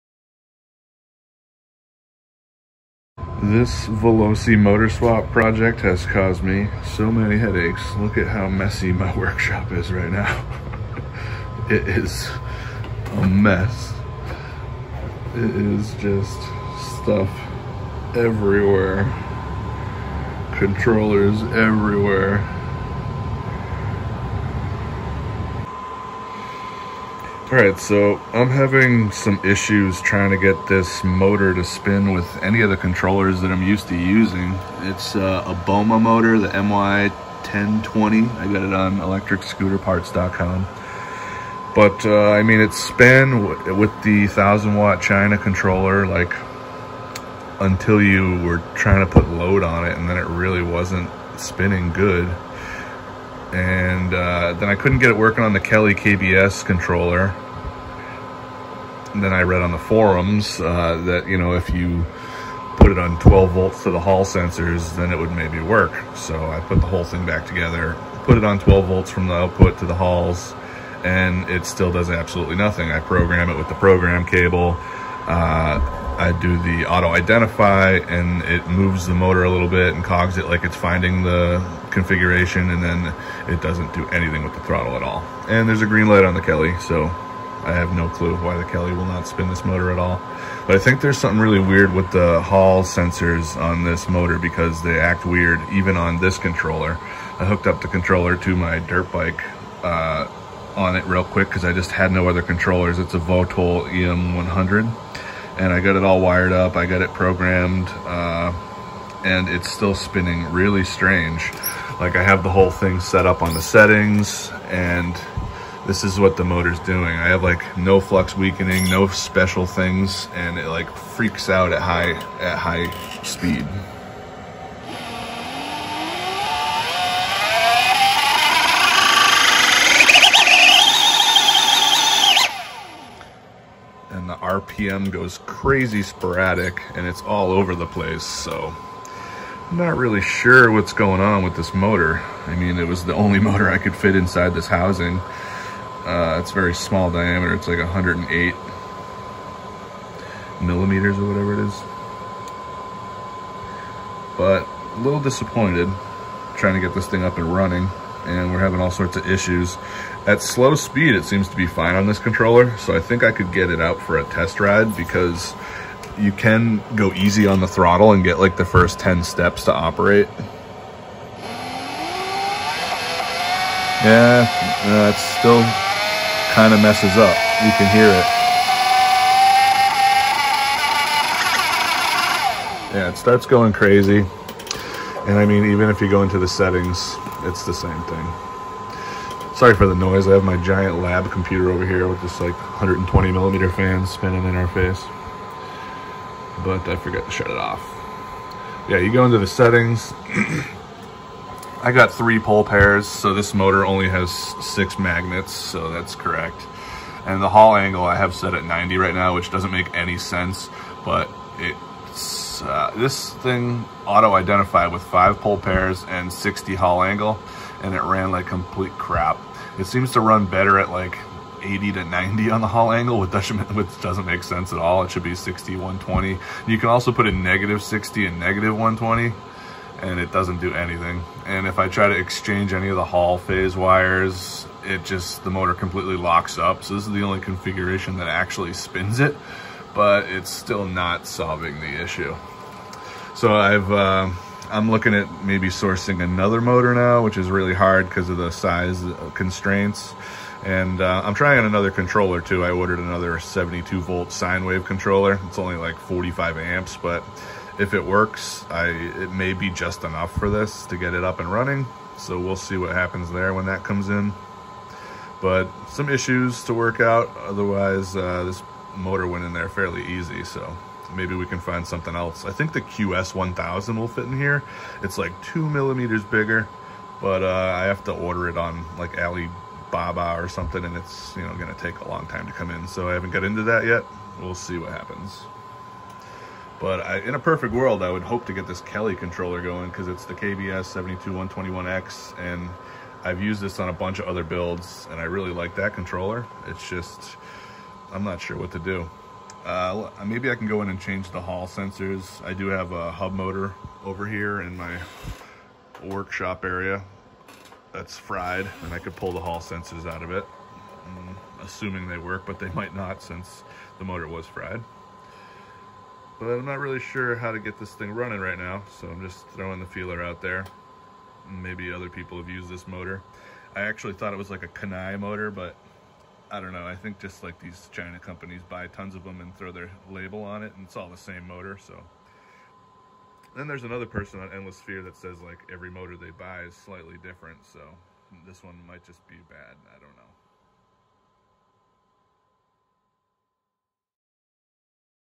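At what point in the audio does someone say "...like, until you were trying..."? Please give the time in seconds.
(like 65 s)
46 s.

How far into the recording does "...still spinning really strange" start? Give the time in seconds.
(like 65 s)
109 s.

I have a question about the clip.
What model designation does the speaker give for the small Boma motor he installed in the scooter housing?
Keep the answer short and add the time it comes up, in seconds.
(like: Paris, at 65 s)
MY1020, at 36 s.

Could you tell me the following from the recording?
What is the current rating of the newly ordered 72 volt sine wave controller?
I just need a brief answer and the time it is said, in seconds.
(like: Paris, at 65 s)
45 amps, at 255 s.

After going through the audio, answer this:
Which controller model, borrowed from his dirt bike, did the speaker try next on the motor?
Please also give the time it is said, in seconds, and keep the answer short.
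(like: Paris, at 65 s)
Votol EM100, at 103 s.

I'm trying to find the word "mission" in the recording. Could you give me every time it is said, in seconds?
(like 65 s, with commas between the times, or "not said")
not said.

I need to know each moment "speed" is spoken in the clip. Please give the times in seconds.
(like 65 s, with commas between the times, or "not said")
123 s, 160 s.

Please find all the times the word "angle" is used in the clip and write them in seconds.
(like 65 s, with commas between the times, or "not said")
207 s, 217 s, 222 s.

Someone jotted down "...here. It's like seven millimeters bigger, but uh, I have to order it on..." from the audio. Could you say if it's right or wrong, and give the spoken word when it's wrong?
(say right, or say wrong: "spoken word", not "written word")
wrong: "two", not "seven".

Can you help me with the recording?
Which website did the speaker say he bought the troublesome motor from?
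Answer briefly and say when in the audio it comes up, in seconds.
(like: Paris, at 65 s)
electricscooterparts.com, at 38 s.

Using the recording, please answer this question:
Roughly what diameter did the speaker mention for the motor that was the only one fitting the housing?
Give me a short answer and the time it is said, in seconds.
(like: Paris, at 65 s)
108 millimeters, at 147 s.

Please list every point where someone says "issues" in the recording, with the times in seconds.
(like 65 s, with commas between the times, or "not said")
29 s, 159 s, 242 s, 266 s.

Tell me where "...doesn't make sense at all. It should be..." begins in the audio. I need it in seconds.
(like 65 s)
224 s.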